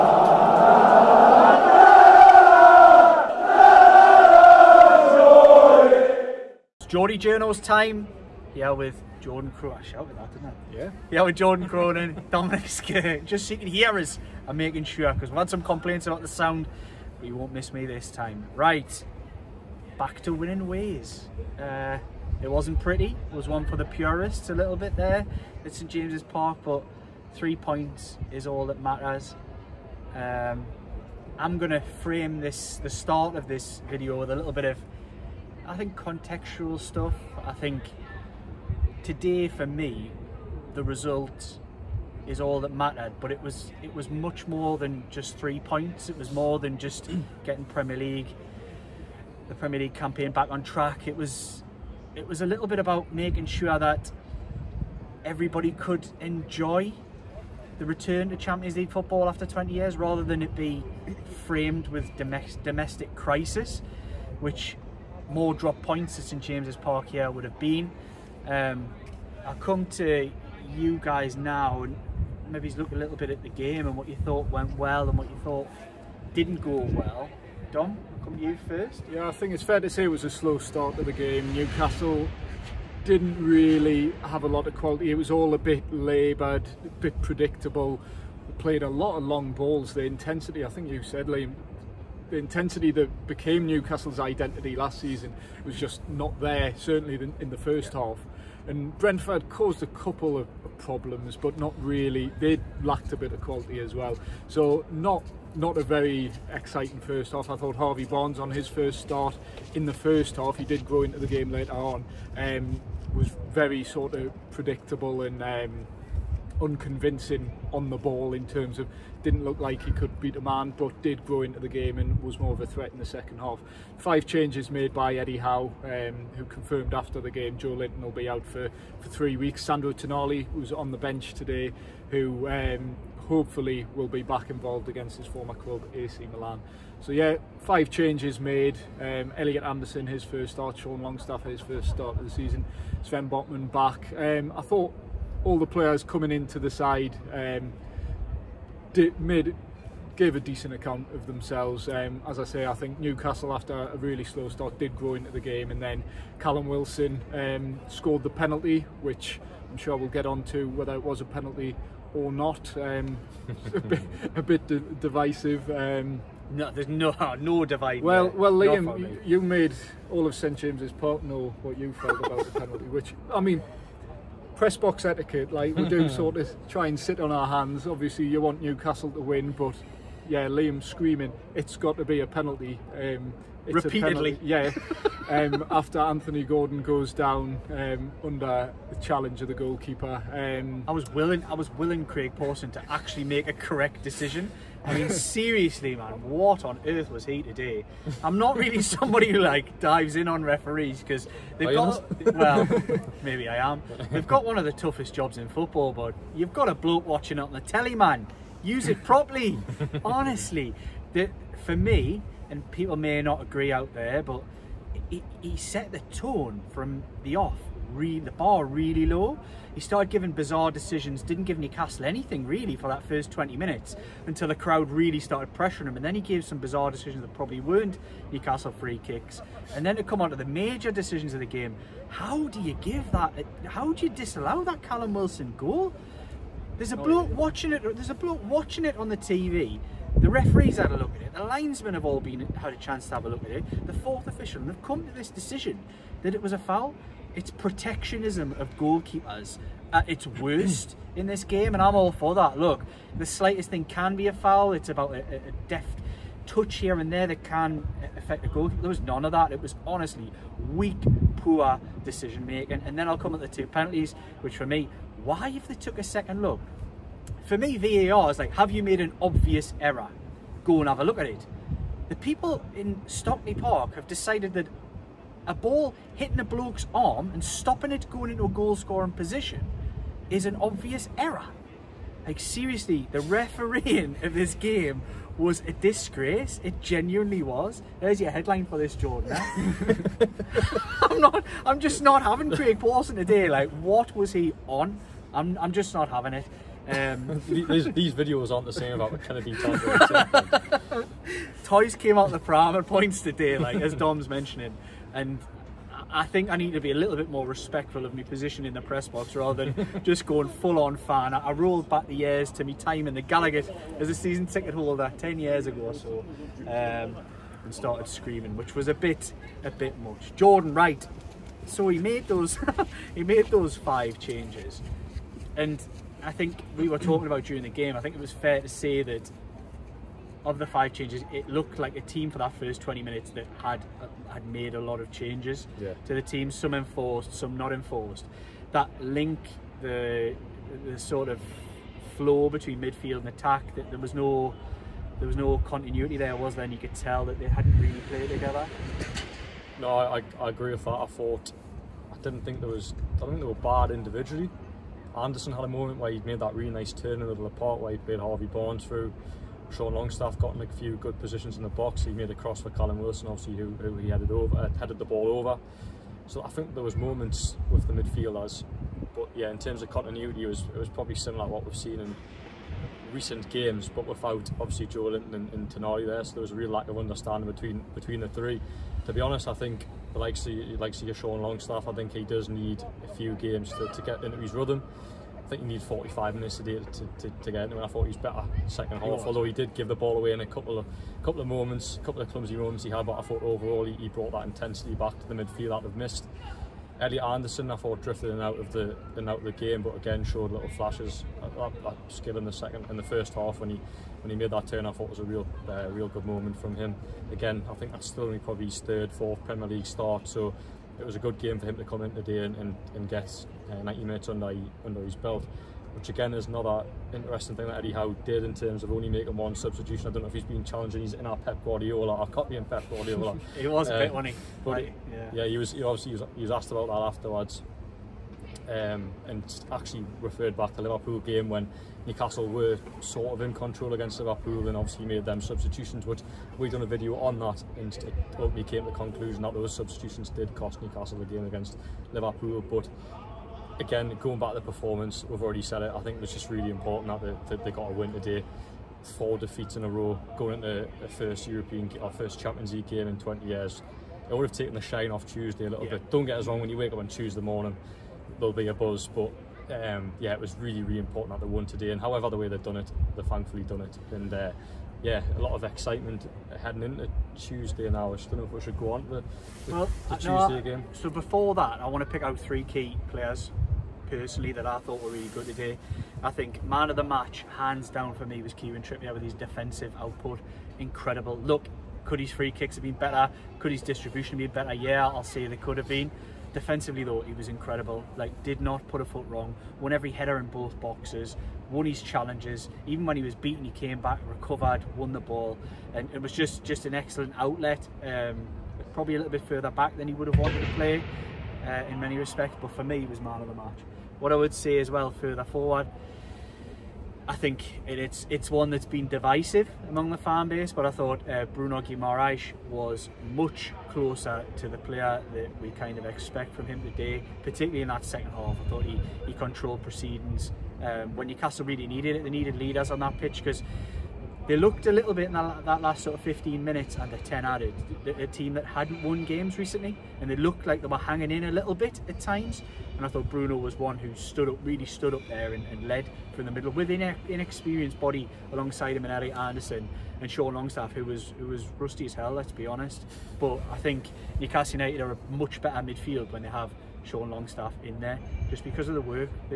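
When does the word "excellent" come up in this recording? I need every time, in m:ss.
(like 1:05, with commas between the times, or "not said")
8:16.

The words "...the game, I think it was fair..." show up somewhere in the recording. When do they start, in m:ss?
5:27.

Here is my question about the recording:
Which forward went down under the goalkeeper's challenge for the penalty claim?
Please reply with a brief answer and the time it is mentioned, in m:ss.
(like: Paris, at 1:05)
Anthony Gordon, at 3:05.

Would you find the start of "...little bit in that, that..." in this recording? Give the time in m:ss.
8:44.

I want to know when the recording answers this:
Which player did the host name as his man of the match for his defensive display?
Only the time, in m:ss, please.
7:58.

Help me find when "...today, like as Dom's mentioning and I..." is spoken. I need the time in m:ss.
5:03.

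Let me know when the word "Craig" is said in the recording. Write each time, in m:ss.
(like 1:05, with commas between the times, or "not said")
3:12, 4:52.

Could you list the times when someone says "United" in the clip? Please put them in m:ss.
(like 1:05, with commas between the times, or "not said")
9:04.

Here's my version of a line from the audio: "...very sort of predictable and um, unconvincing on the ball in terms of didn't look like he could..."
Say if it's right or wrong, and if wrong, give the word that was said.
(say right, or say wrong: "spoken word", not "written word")
right.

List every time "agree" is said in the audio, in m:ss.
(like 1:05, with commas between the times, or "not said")
3:33, 5:50.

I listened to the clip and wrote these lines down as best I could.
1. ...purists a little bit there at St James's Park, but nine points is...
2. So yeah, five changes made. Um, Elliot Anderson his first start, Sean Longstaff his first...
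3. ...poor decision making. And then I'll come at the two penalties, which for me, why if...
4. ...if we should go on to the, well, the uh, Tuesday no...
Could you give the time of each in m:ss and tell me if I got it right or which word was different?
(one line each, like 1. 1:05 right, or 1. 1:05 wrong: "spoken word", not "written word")
1. 0:23 wrong: "three", not "nine"
2. 2:17 right
3. 4:21 right
4. 7:48 right.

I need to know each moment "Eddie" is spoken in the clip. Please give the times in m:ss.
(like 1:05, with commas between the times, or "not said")
2:05, 6:57.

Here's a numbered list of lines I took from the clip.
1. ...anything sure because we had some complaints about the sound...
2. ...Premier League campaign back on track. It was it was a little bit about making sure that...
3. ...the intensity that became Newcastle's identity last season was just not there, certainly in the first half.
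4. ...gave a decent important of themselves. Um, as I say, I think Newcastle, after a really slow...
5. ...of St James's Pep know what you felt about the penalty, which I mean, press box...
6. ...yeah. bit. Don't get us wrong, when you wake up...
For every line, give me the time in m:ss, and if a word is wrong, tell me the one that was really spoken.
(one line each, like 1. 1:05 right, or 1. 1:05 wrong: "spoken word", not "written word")
1. 0:14 wrong: "making", not "anything"
2. 0:49 right
3. 1:32 right
4. 2:30 wrong: "account", not "important"
5. 2:50 wrong: "Park", not "Pep"
6. 7:35 right.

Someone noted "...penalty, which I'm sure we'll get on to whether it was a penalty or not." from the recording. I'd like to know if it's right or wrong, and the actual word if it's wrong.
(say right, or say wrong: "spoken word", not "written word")
right.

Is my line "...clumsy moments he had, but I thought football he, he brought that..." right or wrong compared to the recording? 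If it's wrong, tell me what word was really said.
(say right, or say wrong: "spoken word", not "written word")
wrong: "overall", not "football".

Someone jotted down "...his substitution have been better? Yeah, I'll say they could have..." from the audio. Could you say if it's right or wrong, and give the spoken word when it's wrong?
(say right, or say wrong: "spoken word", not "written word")
wrong: "distribution", not "substitution".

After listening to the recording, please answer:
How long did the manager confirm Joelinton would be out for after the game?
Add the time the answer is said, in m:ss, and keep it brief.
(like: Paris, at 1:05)
3 weeks, at 2:09.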